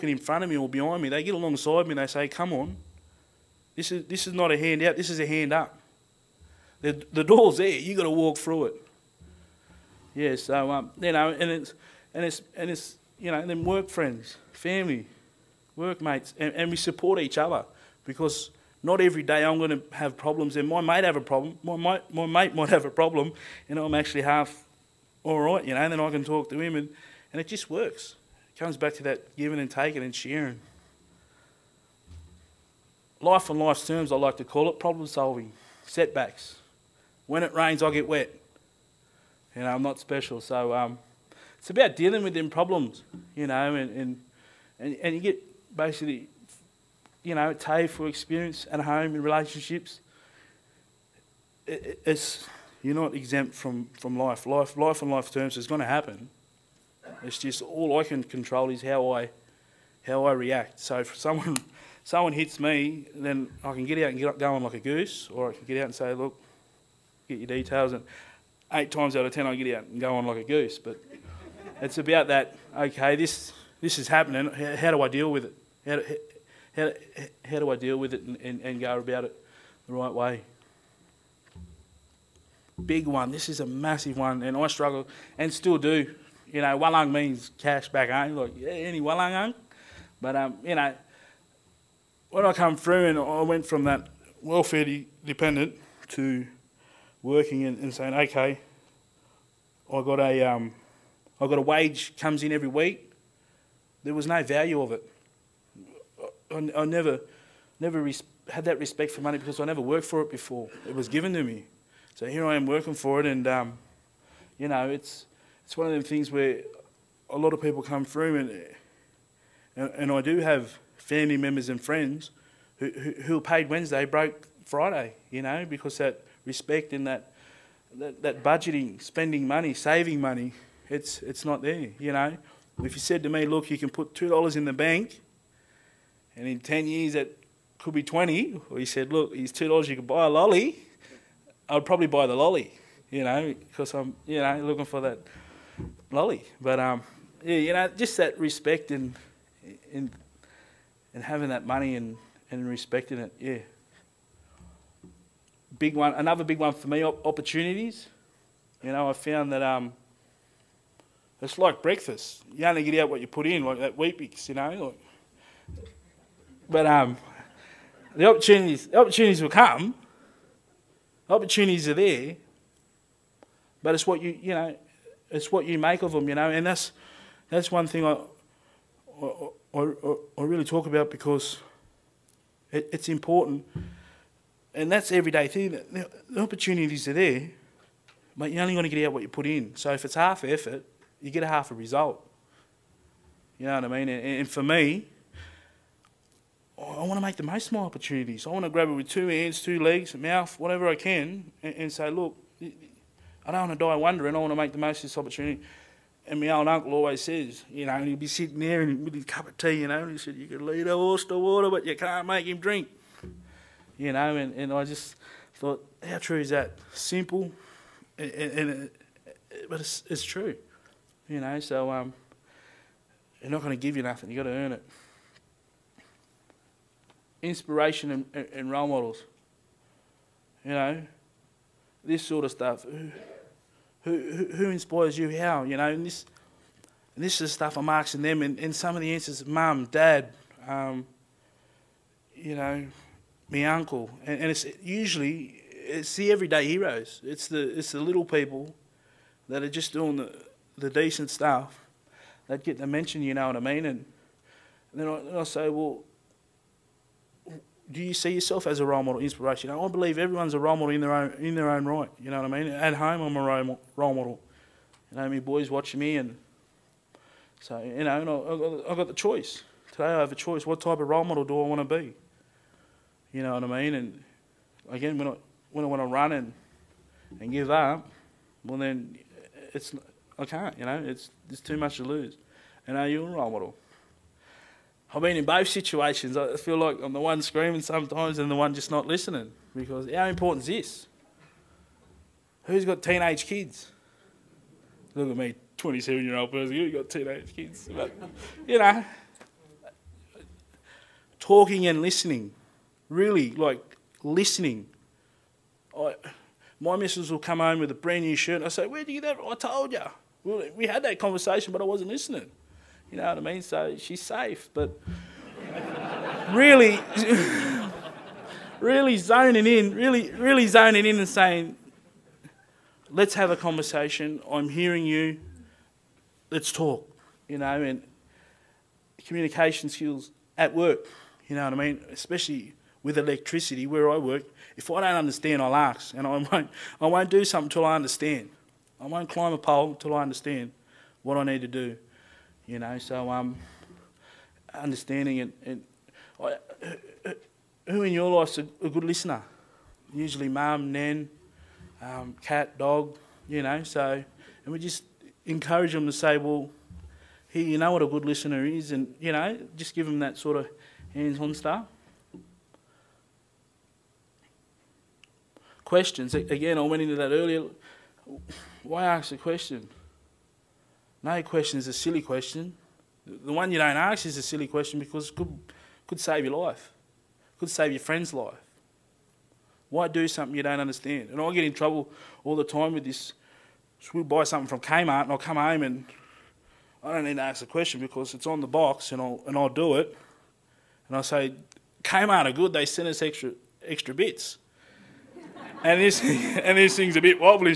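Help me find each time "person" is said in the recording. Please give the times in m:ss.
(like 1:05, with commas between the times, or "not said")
4:56.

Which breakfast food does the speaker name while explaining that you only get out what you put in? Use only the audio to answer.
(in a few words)
weet.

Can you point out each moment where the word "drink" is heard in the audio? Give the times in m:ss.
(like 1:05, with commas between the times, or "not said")
3:32.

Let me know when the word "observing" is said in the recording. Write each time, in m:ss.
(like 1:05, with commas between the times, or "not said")
not said.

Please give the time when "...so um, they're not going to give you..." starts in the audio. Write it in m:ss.
3:41.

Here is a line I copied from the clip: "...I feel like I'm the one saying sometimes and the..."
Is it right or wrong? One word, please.
wrong.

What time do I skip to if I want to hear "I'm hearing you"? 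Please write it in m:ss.
5:24.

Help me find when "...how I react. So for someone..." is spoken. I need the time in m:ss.
1:00.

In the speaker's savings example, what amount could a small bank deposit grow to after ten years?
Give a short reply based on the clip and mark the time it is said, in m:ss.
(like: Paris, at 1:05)
20, at 2:18.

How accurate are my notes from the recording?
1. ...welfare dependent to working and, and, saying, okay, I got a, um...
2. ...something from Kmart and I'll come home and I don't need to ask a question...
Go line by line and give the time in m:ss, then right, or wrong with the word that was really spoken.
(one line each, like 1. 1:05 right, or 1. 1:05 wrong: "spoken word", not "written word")
1. 1:34 right
2. 6:24 right.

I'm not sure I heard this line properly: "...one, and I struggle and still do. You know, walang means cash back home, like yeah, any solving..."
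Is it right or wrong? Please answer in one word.
wrong.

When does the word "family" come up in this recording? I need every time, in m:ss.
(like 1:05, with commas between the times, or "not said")
0:14, 2:00.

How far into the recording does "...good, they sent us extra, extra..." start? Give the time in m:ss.
6:32.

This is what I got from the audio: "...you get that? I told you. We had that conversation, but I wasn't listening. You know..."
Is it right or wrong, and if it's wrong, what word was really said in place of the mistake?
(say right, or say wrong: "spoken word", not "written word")
right.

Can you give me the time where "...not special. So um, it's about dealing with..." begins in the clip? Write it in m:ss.
0:39.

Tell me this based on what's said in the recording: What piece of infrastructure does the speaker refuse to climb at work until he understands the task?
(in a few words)
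a pole.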